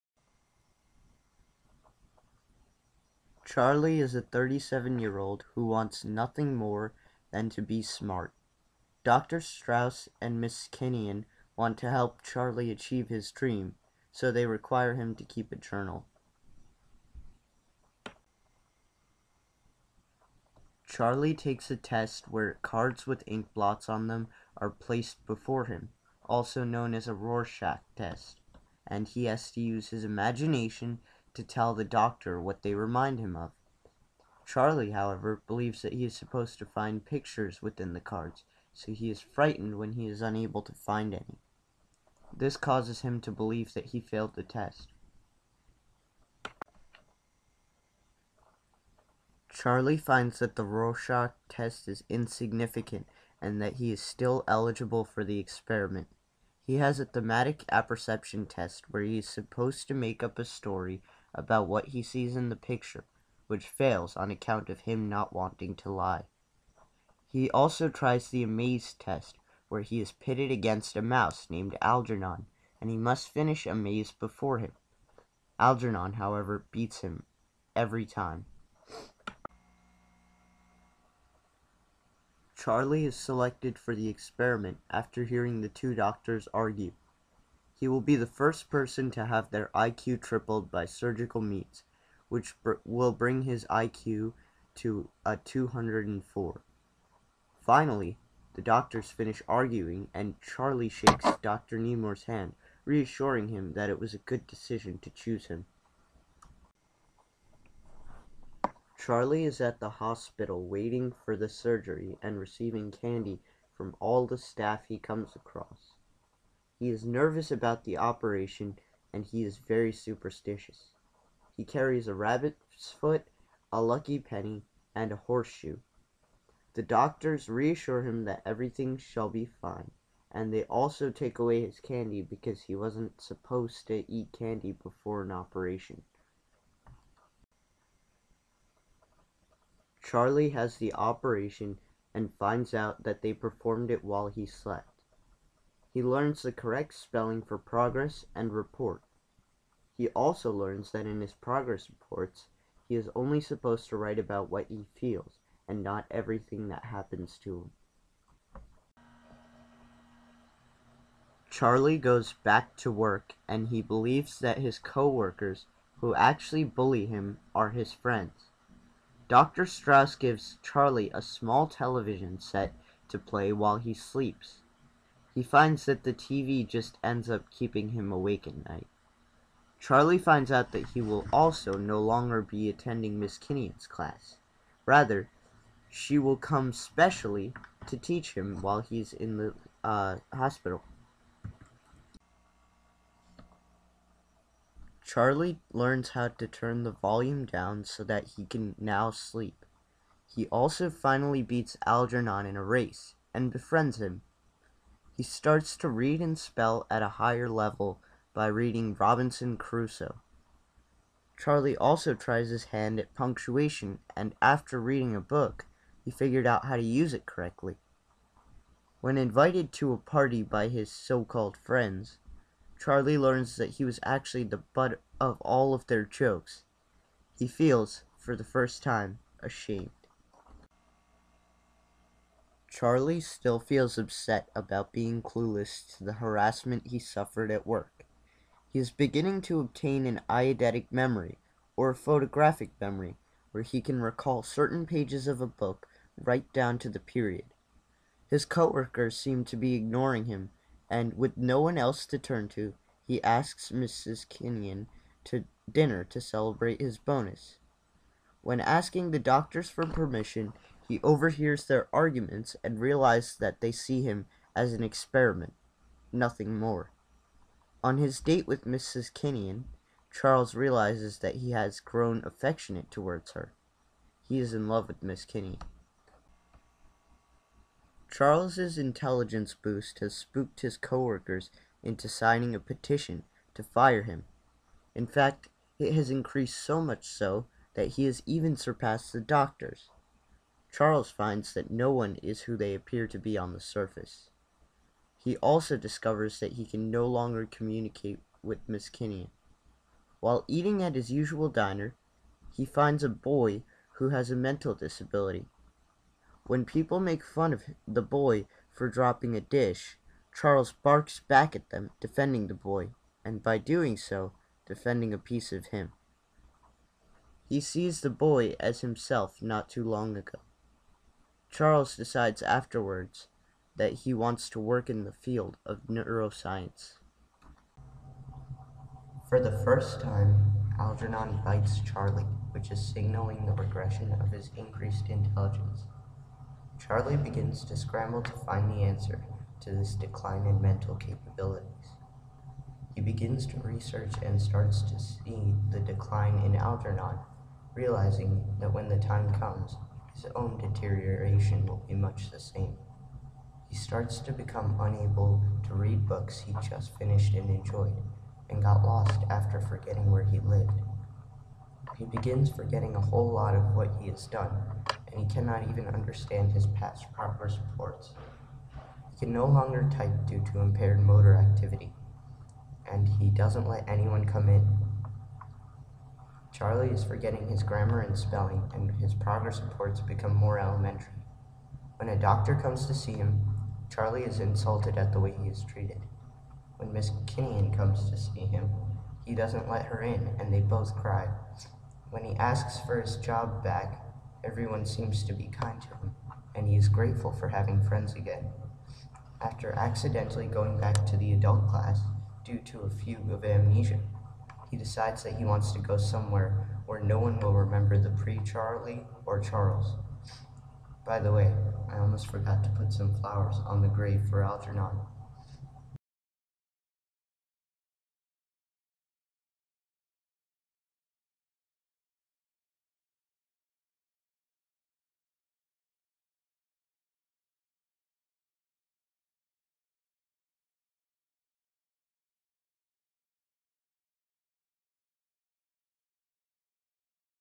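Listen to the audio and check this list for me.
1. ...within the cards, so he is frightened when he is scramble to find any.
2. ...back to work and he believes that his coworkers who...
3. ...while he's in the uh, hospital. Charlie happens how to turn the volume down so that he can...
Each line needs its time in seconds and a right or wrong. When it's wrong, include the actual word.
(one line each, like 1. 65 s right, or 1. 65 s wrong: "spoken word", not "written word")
1. 37 s wrong: "unable", not "scramble"
2. 162 s right
3. 188 s wrong: "learns", not "happens".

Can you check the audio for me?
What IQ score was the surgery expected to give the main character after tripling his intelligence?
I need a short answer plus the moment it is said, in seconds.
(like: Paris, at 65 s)
204, at 95 s.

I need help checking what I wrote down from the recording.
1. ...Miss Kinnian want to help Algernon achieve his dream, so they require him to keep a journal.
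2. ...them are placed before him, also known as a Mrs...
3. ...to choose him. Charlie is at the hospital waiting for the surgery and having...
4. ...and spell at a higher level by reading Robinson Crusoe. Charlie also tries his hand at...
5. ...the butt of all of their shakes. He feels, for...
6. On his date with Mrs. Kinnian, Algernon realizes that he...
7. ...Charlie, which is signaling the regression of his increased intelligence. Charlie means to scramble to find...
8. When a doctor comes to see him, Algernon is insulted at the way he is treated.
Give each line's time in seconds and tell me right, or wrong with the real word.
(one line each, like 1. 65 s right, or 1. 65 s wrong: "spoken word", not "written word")
1. 10 s wrong: "Charlie", not "Algernon"
2. 24 s wrong: "Rorschach", not "Mrs"
3. 104 s wrong: "receiving", not "having"
4. 206 s right
5. 224 s wrong: "jokes", not "shakes"
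6. 267 s wrong: "Charles", not "Algernon"
7. 331 s wrong: "begins", not "means"
8. 381 s wrong: "Charlie", not "Algernon".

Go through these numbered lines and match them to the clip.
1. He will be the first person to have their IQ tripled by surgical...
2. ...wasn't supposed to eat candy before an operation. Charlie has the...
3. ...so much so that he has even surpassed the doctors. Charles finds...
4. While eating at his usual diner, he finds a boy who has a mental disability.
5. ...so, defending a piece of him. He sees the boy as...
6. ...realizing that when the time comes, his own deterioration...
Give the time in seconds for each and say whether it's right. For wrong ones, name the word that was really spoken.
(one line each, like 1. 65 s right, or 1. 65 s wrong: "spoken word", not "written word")
1. 87 s right
2. 132 s right
3. 286 s right
4. 300 s right
5. 313 s right
6. 347 s right.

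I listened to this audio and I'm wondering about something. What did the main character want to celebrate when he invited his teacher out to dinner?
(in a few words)
His bonus.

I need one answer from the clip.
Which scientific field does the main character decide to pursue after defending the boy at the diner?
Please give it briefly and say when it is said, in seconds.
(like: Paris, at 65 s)
Neuroscience, at 325 s.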